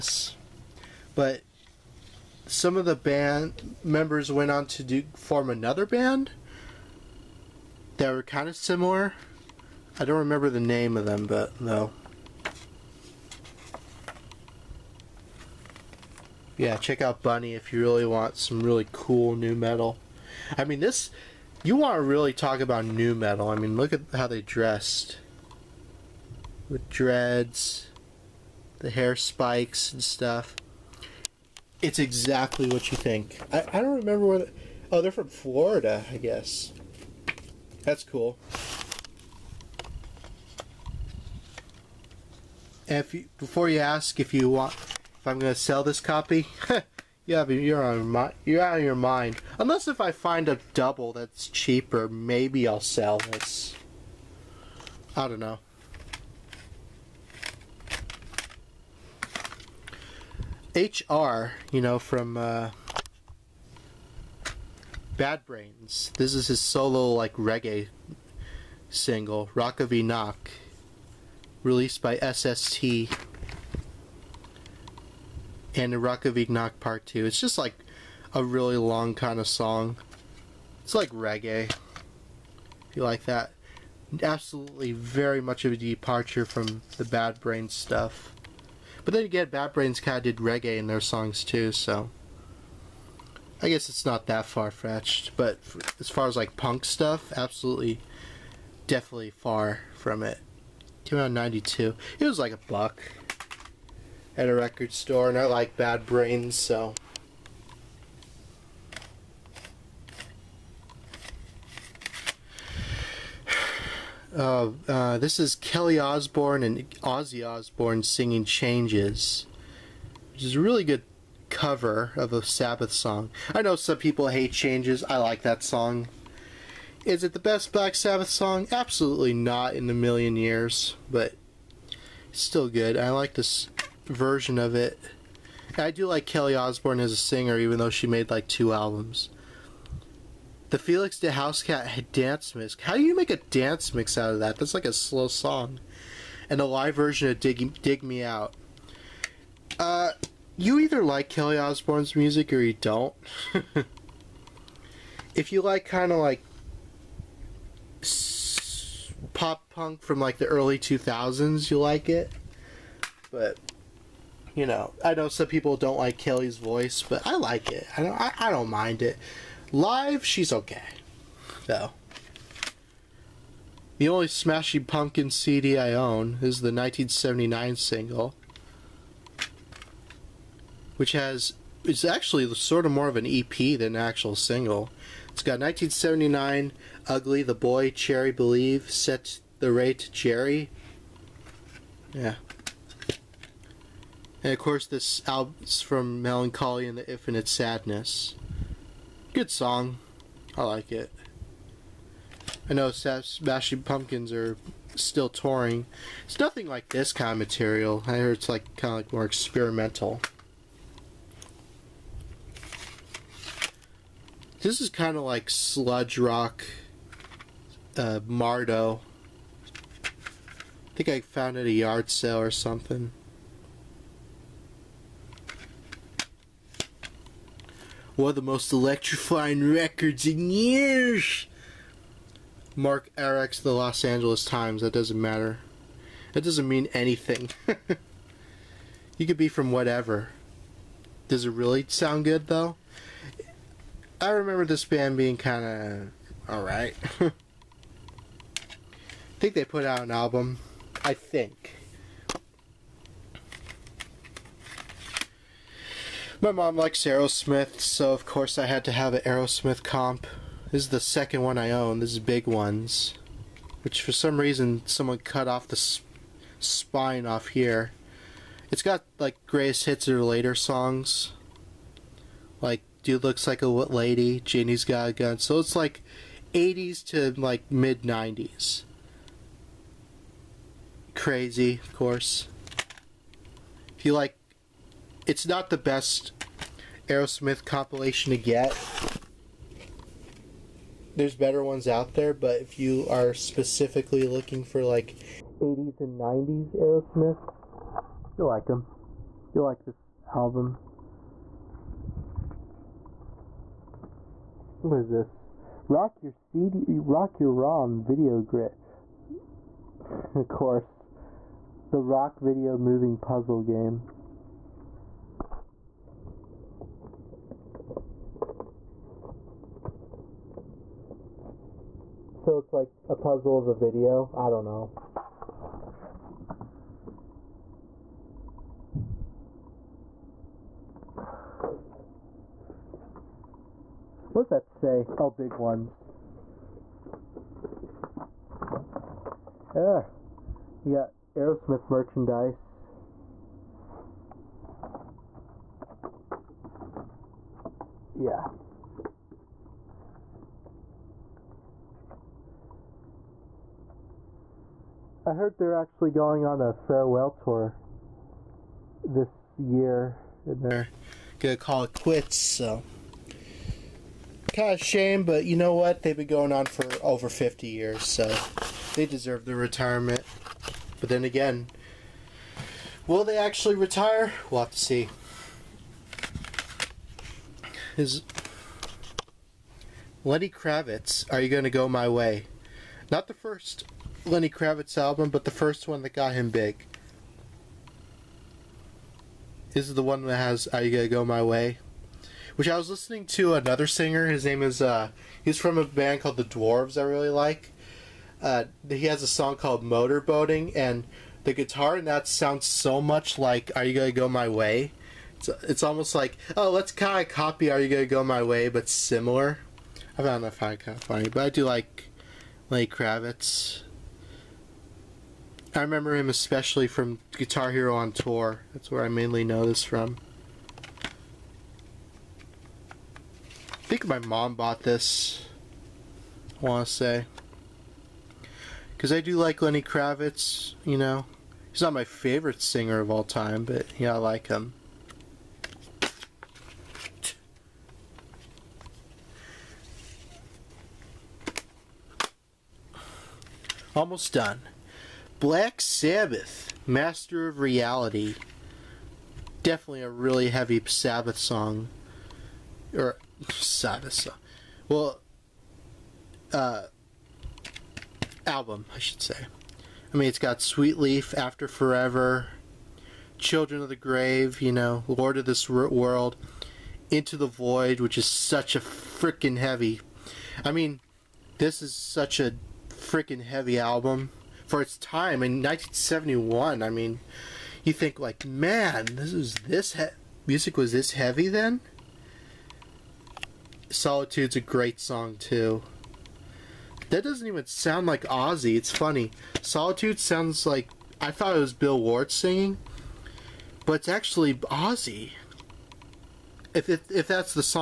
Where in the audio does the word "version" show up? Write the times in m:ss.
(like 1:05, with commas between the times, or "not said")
2:14, 2:26.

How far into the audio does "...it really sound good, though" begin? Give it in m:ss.
4:01.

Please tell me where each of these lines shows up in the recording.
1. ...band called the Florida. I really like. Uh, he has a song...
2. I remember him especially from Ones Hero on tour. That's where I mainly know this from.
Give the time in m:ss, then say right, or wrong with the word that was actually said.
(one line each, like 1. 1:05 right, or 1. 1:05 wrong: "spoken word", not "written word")
1. 6:35 wrong: "Dwarves", not "Florida"
2. 6:55 wrong: "Guitar", not "Ones".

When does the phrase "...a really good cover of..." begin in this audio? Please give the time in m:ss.
2:00.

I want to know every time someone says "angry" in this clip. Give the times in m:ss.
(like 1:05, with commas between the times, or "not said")
not said.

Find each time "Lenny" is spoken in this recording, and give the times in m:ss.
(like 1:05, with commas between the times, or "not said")
6:20, 6:24, 6:52, 7:09.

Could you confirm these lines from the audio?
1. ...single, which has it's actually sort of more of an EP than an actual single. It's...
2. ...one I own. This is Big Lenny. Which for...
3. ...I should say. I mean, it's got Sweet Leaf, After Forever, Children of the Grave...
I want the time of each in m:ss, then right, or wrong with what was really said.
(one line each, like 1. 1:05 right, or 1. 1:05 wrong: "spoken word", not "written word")
1. 2:57 right
2. 4:21 wrong: "Ones", not "Lenny"
3. 7:38 right.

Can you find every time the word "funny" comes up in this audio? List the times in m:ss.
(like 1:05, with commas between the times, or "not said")
6:51, 8:08.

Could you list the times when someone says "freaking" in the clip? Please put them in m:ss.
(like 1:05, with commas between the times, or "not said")
7:48, 7:52.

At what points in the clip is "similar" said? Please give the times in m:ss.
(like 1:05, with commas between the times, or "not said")
0:08, 6:48.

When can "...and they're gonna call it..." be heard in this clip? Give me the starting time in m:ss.
6:00.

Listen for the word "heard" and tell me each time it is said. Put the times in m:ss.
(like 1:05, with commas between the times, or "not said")
3:28, 5:55.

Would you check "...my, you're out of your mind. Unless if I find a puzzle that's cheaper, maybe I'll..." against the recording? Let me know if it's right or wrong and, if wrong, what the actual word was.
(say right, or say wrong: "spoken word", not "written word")
wrong: "double", not "puzzle".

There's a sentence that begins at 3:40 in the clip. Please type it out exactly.
I think I found it at a yard sale or something.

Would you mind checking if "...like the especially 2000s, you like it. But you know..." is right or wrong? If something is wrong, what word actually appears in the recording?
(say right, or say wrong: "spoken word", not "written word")
wrong: "early", not "especially".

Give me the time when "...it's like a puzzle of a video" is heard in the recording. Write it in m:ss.
5:22.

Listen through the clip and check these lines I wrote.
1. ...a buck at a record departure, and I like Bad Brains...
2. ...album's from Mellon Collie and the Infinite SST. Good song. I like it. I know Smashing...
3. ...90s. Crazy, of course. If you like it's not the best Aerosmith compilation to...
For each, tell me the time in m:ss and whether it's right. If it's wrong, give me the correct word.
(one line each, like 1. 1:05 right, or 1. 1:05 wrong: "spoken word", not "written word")
1. 1:42 wrong: "store", not "departure"
2. 3:15 wrong: "Sadness", not "SST"
3. 4:38 right.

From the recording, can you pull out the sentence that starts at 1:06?
This is his solo like reggae single, Rock of Enoch, released by SST and Rakavignak Part 2.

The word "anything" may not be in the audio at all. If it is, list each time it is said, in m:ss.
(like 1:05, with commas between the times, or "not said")
3:56.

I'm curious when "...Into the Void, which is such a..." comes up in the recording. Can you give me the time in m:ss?
7:47.